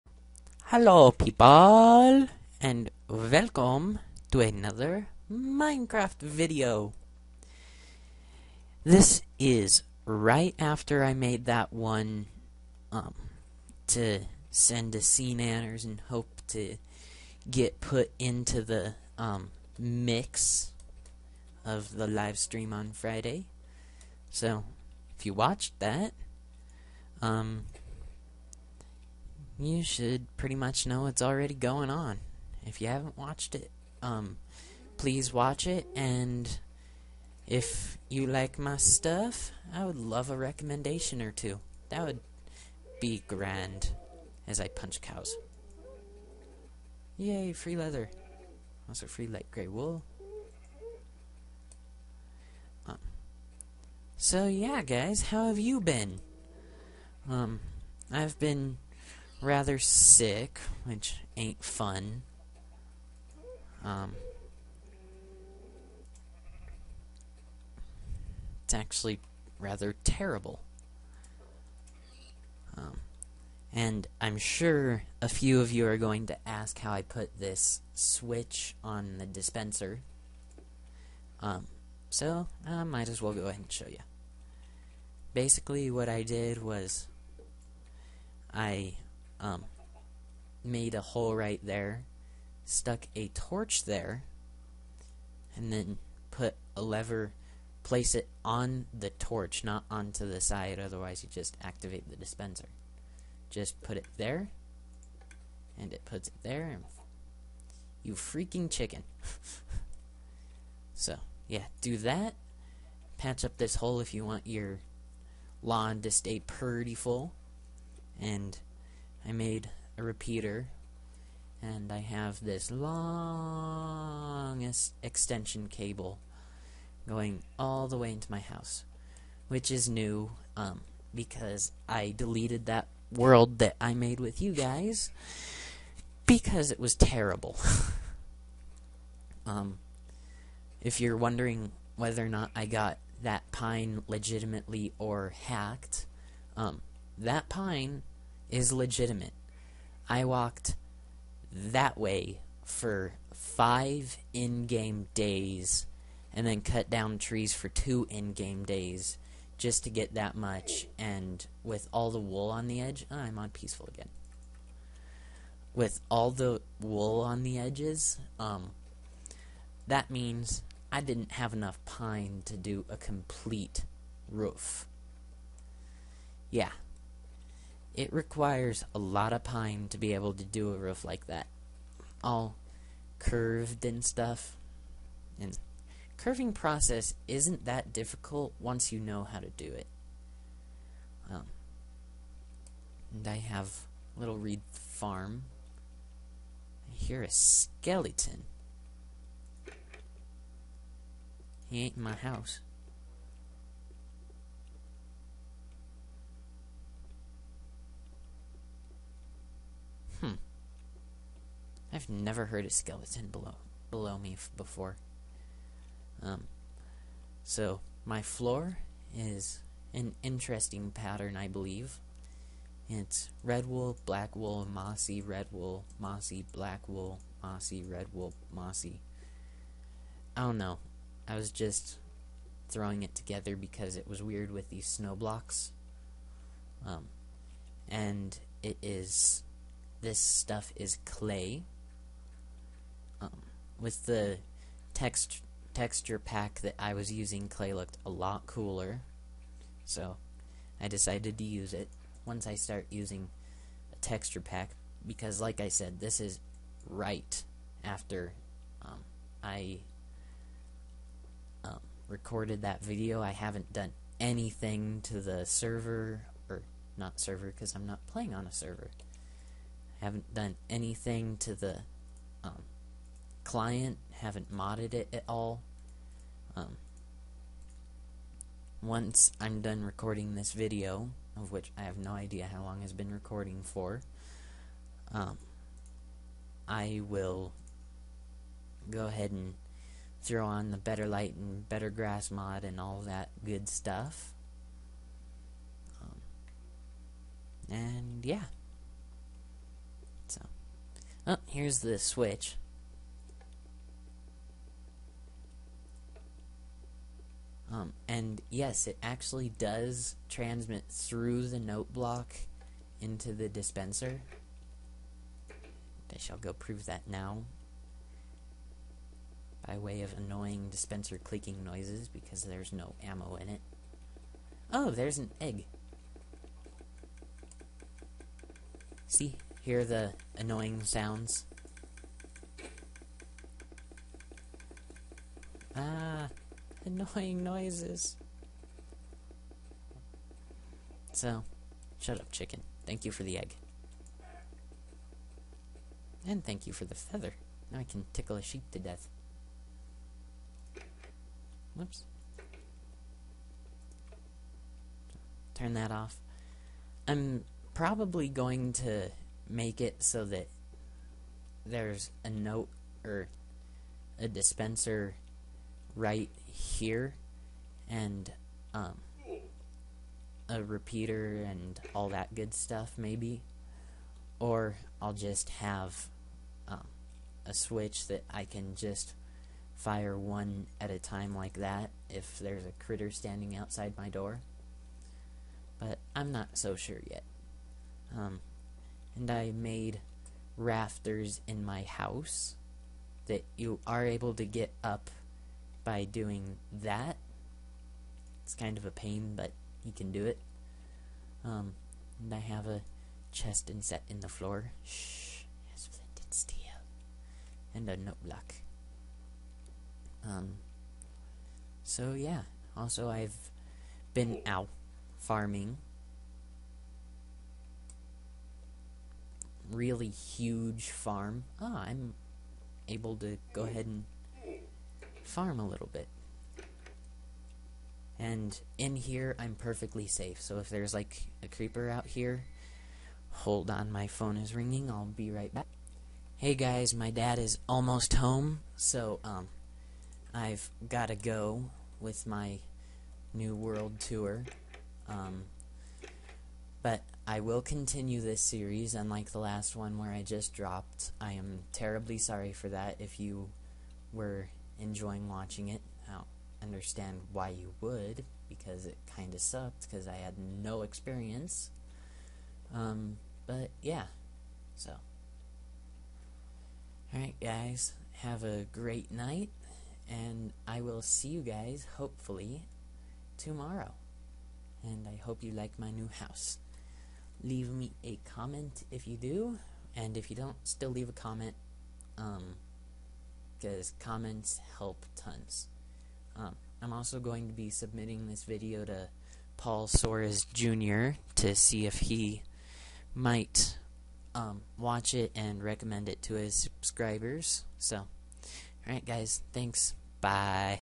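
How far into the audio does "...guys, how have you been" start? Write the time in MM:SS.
00:54.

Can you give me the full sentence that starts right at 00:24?
So if you watched that, um, you should pretty much know it's already going on.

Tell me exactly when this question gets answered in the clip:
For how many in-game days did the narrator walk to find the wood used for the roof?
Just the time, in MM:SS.
02:33.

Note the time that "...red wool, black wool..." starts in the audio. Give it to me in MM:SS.
03:43.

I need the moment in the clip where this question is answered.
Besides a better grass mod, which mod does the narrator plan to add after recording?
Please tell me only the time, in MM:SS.
04:50.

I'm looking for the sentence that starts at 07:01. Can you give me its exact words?
Ah, I'm able to go ahead and farm a little bit.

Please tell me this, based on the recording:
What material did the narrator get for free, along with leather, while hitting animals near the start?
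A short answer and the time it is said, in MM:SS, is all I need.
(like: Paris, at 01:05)
light gray wool, at 00:49.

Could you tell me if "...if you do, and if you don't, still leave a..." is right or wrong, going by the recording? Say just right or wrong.
right.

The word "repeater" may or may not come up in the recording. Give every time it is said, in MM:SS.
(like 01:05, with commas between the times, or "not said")
02:00, 06:10.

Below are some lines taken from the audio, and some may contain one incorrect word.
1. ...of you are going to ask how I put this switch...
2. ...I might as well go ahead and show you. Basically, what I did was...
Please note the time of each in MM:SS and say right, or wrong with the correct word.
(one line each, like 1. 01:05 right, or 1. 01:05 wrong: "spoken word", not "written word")
1. 01:15 right
2. 01:22 right.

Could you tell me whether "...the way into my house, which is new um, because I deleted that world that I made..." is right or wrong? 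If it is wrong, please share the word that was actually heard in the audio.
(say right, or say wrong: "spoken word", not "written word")
right.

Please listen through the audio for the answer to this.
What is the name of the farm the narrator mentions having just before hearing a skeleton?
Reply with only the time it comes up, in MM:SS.
03:14.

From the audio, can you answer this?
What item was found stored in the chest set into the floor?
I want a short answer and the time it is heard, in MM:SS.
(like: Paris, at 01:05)
flint and steel, at 06:45.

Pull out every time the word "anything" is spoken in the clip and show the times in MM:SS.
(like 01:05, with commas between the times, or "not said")
04:24, 04:30.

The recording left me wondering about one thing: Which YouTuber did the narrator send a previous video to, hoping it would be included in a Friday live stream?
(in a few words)
SeaNanners.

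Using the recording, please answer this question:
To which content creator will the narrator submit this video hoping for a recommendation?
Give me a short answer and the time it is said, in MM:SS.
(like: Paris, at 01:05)
Paul Soares Jr., at 08:09.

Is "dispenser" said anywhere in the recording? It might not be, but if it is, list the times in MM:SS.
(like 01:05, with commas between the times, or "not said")
01:19, 01:42, 05:13, 05:20, 06:04.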